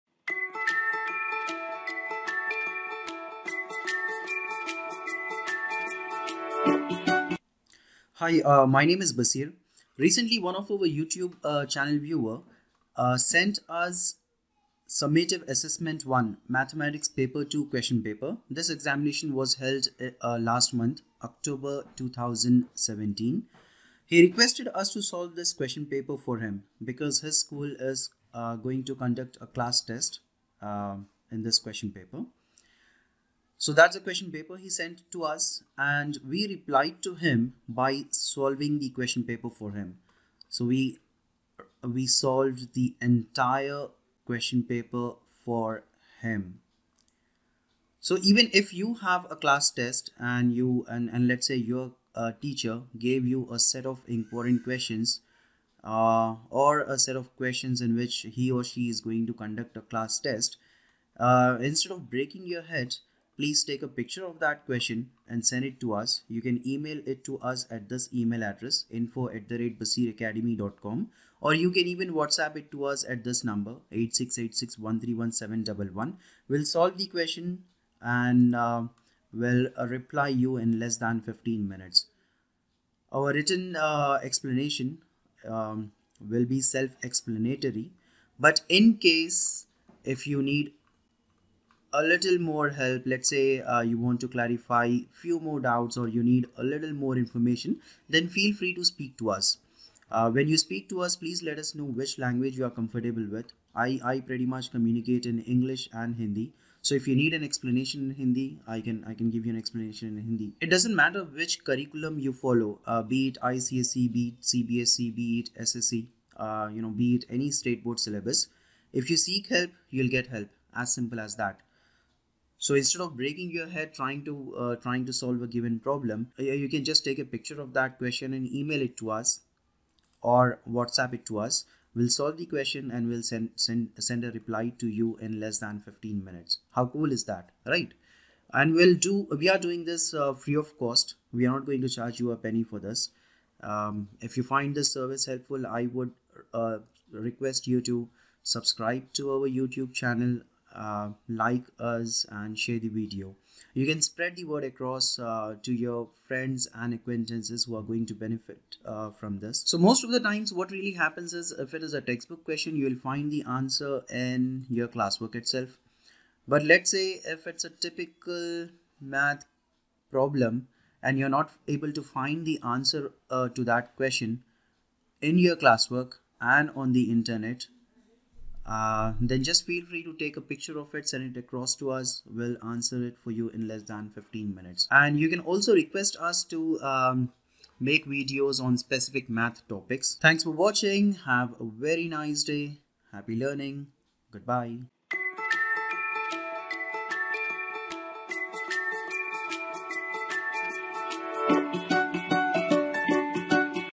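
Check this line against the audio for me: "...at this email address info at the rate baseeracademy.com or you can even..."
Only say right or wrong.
right.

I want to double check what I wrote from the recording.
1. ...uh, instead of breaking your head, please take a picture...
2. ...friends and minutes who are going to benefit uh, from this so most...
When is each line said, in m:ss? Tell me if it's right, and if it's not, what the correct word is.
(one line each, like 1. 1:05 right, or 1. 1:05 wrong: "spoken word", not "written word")
1. 1:01 right
2. 2:36 wrong: "acquaintances", not "minutes".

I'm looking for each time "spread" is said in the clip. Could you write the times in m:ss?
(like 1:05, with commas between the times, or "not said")
2:34.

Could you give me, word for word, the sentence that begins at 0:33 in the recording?
So that's a question paper he sent to us and we replied to him by solving the question paper for him.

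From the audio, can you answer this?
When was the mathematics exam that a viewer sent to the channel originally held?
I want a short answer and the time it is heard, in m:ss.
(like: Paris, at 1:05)
October 2017, at 0:21.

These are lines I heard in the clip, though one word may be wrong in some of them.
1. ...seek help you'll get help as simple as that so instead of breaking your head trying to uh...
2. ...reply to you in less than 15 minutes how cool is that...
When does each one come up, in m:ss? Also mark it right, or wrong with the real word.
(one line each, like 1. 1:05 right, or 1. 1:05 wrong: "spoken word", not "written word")
1. 1:59 right
2. 2:14 right.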